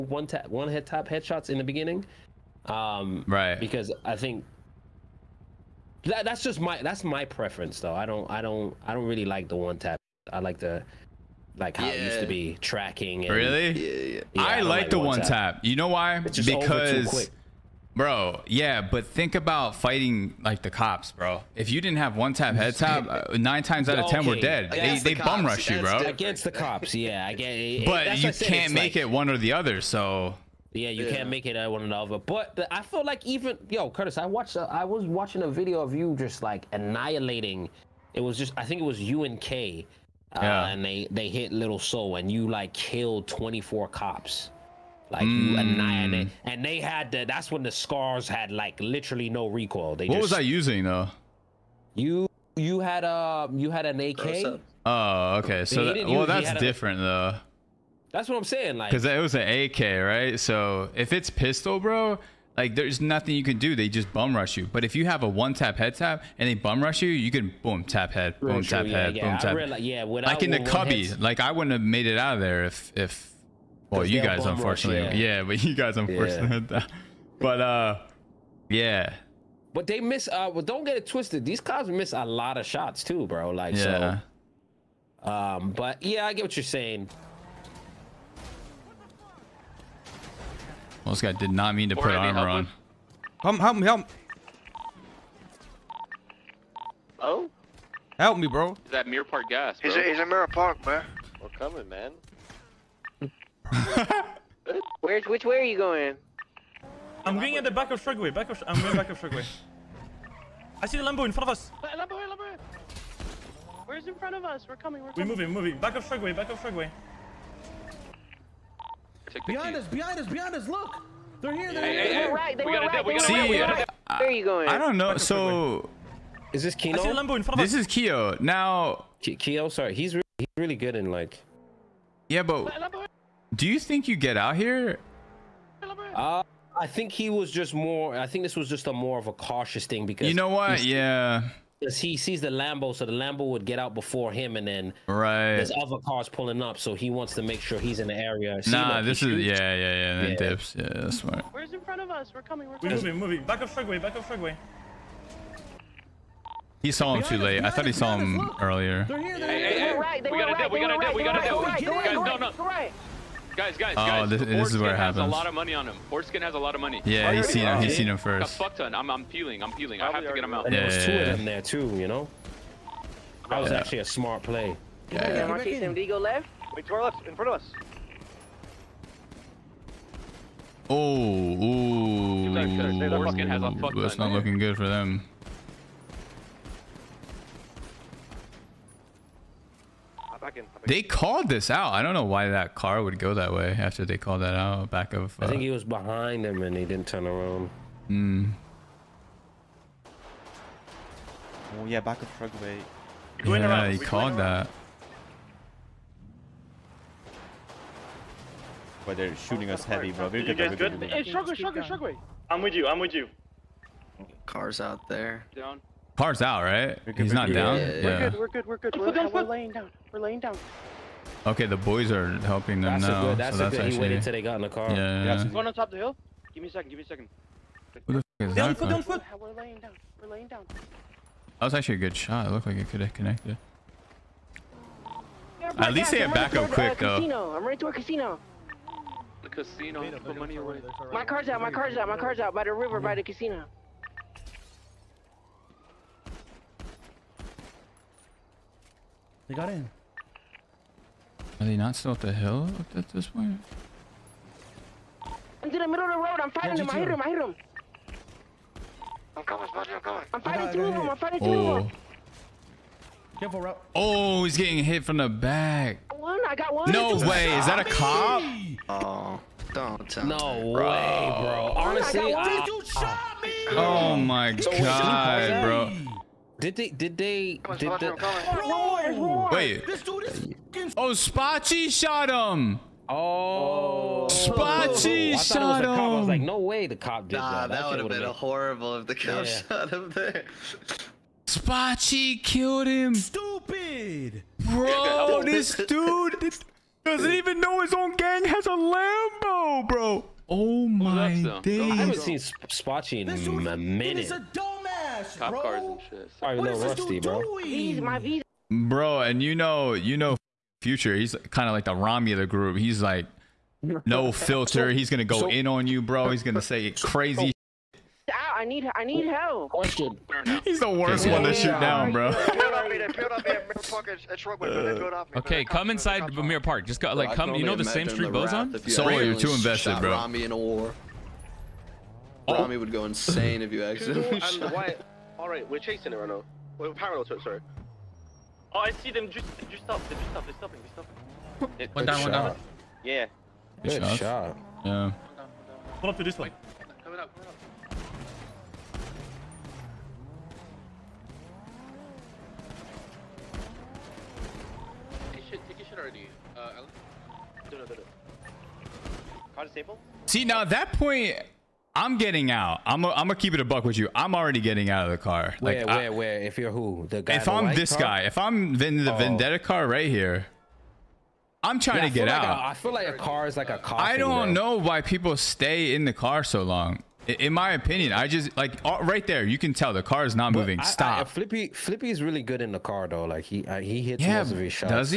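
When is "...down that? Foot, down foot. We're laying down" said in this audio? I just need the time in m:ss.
3:48.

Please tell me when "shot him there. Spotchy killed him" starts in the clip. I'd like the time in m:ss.
4:49.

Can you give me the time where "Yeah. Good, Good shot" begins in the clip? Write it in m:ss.
5:43.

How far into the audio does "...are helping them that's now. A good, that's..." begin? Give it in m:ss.
3:42.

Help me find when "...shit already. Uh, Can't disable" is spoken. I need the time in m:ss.
5:55.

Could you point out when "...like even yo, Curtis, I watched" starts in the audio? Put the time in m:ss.
0:33.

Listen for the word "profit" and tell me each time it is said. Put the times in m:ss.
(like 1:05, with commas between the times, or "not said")
not said.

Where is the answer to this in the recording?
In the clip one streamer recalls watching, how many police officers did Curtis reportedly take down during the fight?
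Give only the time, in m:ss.
0:43.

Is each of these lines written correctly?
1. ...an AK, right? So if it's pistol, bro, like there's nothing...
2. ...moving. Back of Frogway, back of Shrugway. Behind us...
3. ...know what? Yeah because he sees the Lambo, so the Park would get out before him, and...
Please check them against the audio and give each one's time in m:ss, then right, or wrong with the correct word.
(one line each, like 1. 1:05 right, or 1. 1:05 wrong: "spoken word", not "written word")
1. 0:59 right
2. 1:55 wrong: "Shrugway", not "Frogway"
3. 2:20 wrong: "Lambo", not "Park".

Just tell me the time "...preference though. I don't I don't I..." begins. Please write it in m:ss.
0:07.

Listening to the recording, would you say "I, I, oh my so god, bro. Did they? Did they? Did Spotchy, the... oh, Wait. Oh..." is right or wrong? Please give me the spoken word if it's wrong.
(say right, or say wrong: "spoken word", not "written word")
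right.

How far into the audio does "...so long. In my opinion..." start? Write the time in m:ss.
6:16.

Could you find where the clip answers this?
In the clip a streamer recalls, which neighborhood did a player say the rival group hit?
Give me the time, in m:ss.
0:41.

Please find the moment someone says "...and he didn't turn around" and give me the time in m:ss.
3:16.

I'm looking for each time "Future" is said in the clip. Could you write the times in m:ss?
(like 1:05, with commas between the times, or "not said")
5:10.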